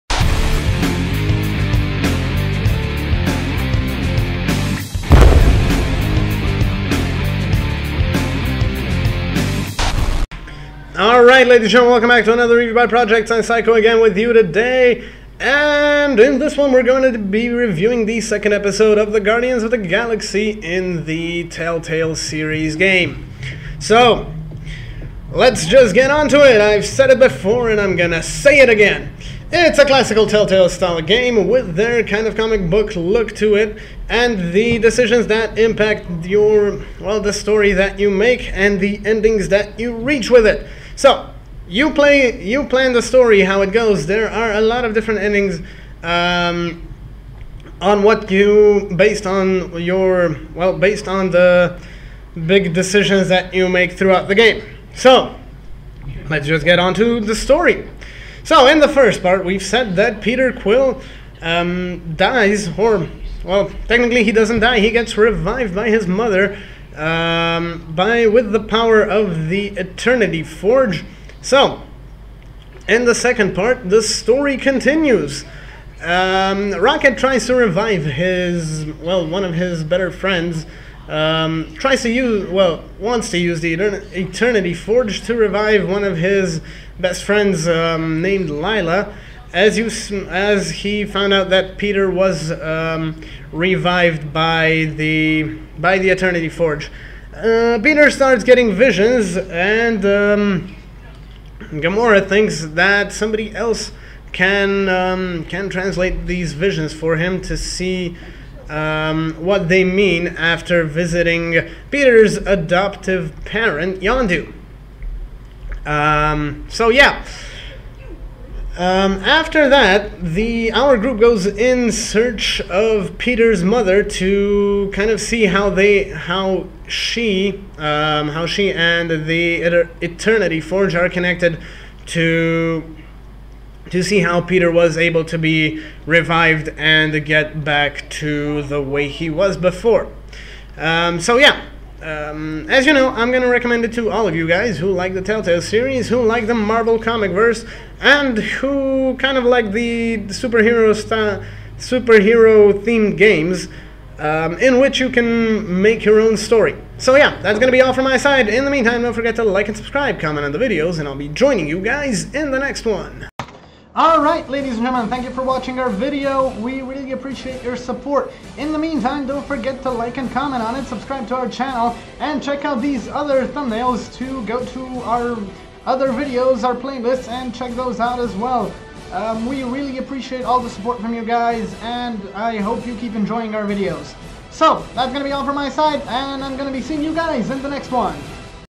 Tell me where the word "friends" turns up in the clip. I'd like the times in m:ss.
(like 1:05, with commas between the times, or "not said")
1:20, 1:27.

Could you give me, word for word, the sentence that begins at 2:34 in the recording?
Um, in which you can make your own story.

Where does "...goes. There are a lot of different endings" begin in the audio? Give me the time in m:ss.
0:43.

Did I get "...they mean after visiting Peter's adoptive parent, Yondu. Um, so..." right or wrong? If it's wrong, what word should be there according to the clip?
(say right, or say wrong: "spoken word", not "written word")
right.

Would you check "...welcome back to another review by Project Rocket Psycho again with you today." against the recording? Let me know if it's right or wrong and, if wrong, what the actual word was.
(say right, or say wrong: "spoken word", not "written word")
wrong: "Science", not "Rocket".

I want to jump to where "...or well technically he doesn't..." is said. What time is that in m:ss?
1:02.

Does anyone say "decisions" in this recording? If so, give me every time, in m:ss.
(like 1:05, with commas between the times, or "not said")
0:34, 0:52.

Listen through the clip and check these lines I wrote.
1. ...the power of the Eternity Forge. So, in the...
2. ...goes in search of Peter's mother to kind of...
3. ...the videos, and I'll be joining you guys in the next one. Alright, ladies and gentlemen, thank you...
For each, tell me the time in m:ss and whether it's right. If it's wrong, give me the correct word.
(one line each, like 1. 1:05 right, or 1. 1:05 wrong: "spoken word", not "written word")
1. 1:08 right
2. 2:01 right
3. 2:40 right.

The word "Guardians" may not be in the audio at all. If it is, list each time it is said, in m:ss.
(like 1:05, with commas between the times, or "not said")
0:19.